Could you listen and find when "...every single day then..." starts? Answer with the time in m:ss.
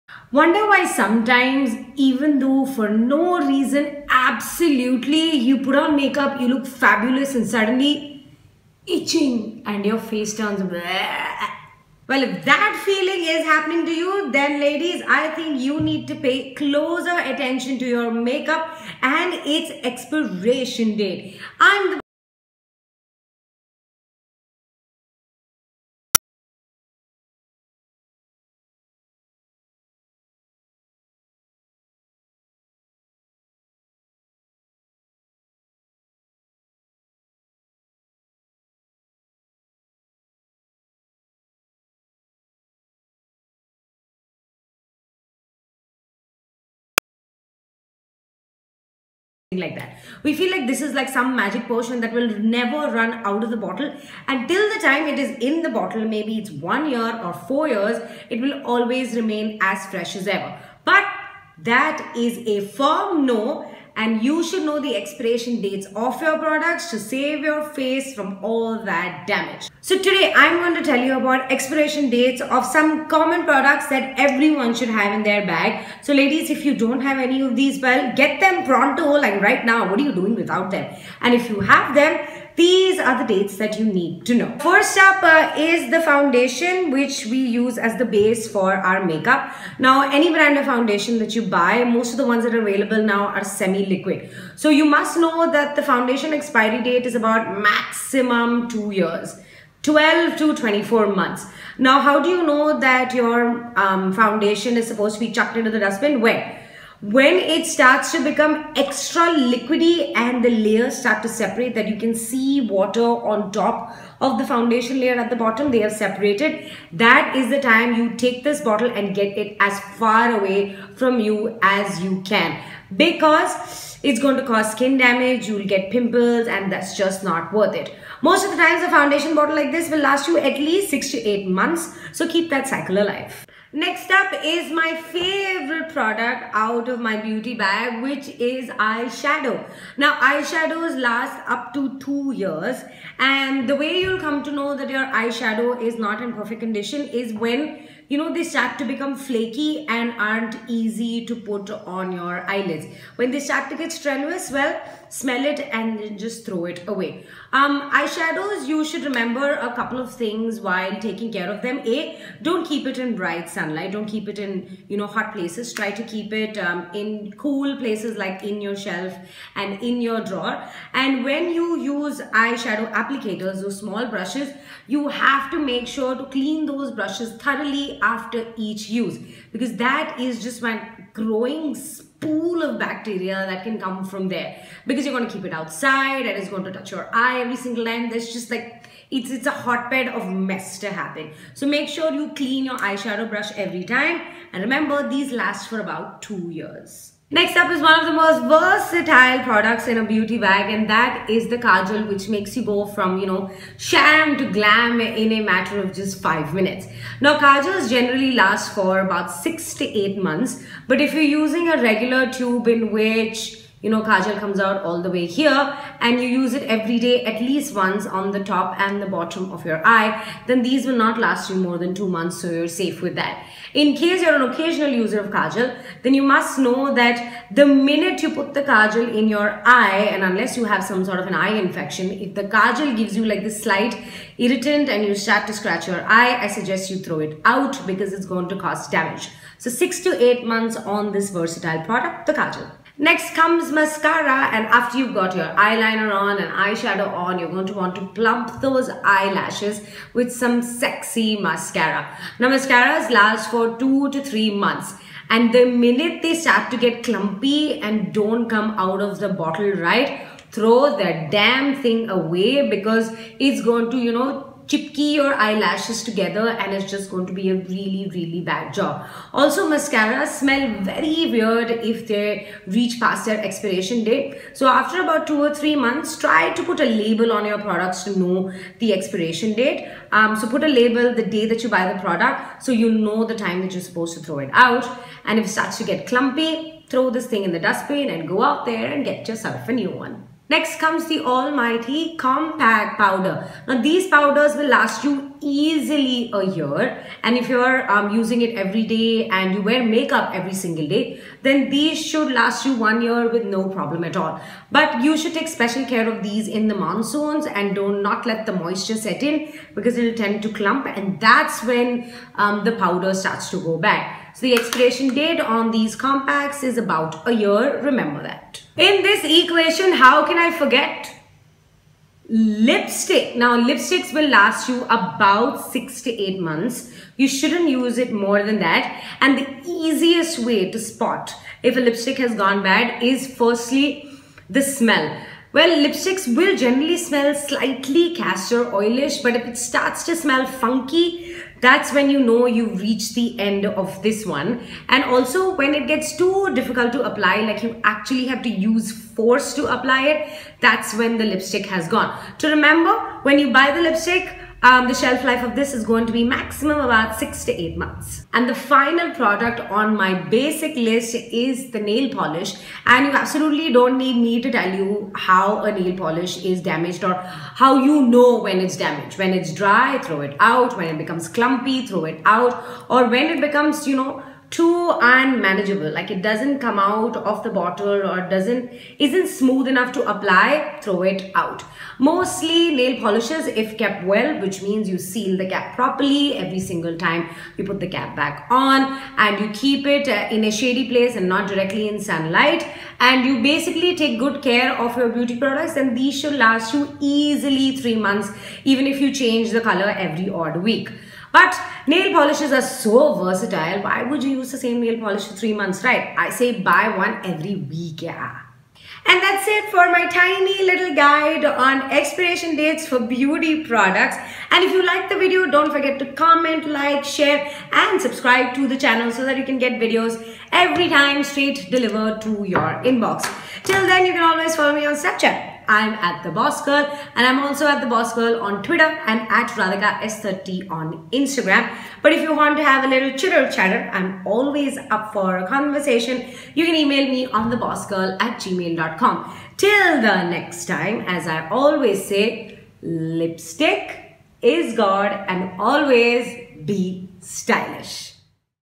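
5:00.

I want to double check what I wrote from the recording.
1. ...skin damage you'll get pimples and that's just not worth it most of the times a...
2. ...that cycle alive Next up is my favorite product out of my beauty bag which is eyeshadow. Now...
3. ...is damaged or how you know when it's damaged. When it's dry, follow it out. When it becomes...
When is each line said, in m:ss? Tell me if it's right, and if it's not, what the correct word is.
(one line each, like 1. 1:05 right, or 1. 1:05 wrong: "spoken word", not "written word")
1. 2:04 right
2. 2:12 right
3. 6:06 wrong: "throw", not "follow".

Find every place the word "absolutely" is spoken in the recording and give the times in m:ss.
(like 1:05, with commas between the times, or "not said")
0:04, 6:03.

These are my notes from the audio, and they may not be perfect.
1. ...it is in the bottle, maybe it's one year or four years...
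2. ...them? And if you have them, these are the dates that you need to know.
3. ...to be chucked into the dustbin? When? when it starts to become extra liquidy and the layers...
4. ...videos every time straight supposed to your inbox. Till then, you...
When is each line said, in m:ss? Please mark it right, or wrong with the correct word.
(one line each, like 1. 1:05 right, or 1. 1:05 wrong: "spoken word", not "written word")
1. 0:55 right
2. 1:20 right
3. 1:45 right
4. 6:59 wrong: "delivered", not "supposed".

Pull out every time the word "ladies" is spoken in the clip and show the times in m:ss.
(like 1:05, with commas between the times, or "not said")
0:14, 1:16.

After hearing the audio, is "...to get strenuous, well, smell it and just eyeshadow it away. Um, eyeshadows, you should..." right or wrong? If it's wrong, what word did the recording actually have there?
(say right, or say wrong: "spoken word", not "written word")
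wrong: "throw", not "eyeshadow".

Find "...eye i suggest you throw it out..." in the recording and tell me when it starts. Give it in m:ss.
3:56.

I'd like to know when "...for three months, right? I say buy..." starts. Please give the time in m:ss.
6:45.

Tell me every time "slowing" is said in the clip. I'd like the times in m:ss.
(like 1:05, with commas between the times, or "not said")
not said.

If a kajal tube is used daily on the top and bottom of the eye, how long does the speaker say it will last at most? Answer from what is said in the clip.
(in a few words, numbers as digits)
2 months.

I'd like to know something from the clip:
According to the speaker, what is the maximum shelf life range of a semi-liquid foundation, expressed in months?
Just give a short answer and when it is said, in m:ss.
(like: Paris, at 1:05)
12 to 24 months, at 1:39.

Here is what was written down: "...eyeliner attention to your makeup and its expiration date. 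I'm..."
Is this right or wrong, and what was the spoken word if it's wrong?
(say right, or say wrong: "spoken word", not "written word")
wrong: "closer", not "eyeliner".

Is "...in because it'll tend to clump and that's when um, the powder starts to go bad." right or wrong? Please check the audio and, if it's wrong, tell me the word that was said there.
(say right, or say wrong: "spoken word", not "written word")
right.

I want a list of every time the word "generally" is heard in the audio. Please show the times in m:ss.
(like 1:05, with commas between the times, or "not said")
3:27, 5:36.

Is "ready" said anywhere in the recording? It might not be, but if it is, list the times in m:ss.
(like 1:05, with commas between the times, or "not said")
not said.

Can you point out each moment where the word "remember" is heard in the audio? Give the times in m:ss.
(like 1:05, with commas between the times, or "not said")
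2:39, 3:14, 5:17, 5:52.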